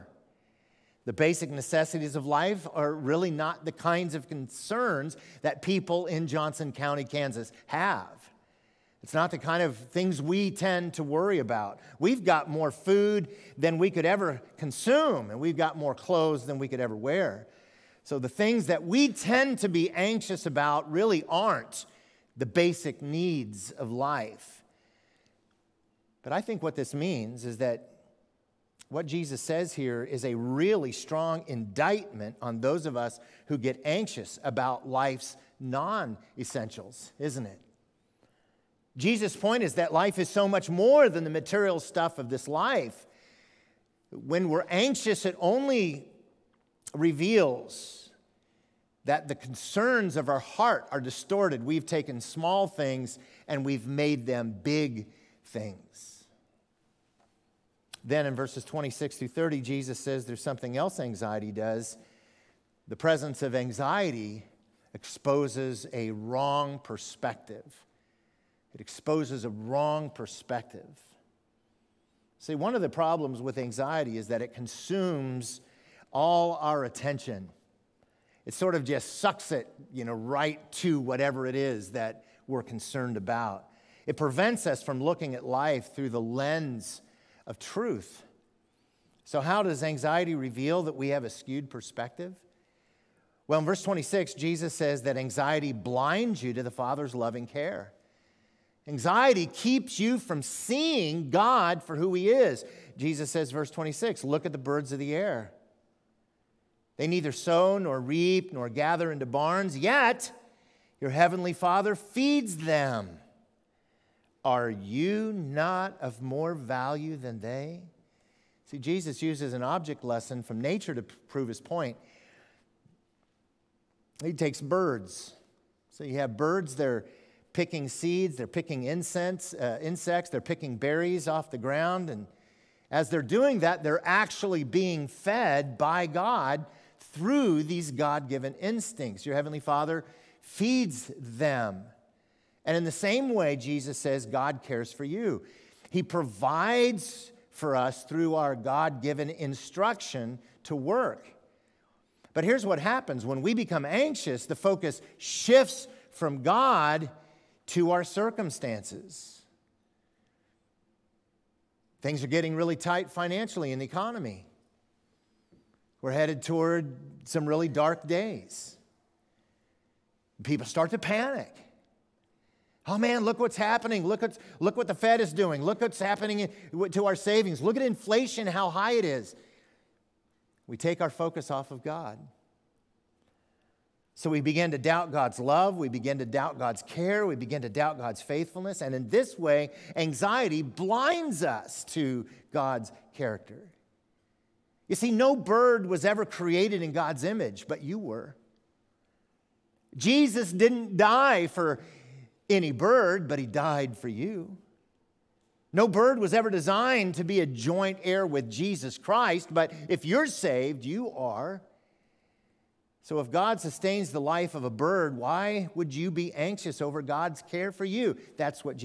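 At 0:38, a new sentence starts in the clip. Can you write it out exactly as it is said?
Jesus' point is that life is so much more than the material stuff of this life.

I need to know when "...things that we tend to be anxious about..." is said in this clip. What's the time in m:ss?
0:18.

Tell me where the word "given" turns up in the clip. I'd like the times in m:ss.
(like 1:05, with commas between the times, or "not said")
2:18, 2:29.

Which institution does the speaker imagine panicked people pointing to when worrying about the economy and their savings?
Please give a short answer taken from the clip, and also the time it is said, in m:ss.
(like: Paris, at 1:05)
The Fed, at 2:54.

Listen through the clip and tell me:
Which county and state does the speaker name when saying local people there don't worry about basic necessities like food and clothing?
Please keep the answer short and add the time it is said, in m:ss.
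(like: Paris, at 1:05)
Johnson County, Kansas, at 0:06.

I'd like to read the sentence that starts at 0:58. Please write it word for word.
Then in verses 26 through 30, Jesus says there's something else anxiety does.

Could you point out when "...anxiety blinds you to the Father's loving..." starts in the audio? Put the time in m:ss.
1:35.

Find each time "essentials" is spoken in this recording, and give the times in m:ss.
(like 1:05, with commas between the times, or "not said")
0:36.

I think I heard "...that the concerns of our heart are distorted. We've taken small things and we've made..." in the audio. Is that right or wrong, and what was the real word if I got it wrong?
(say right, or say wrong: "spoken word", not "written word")
right.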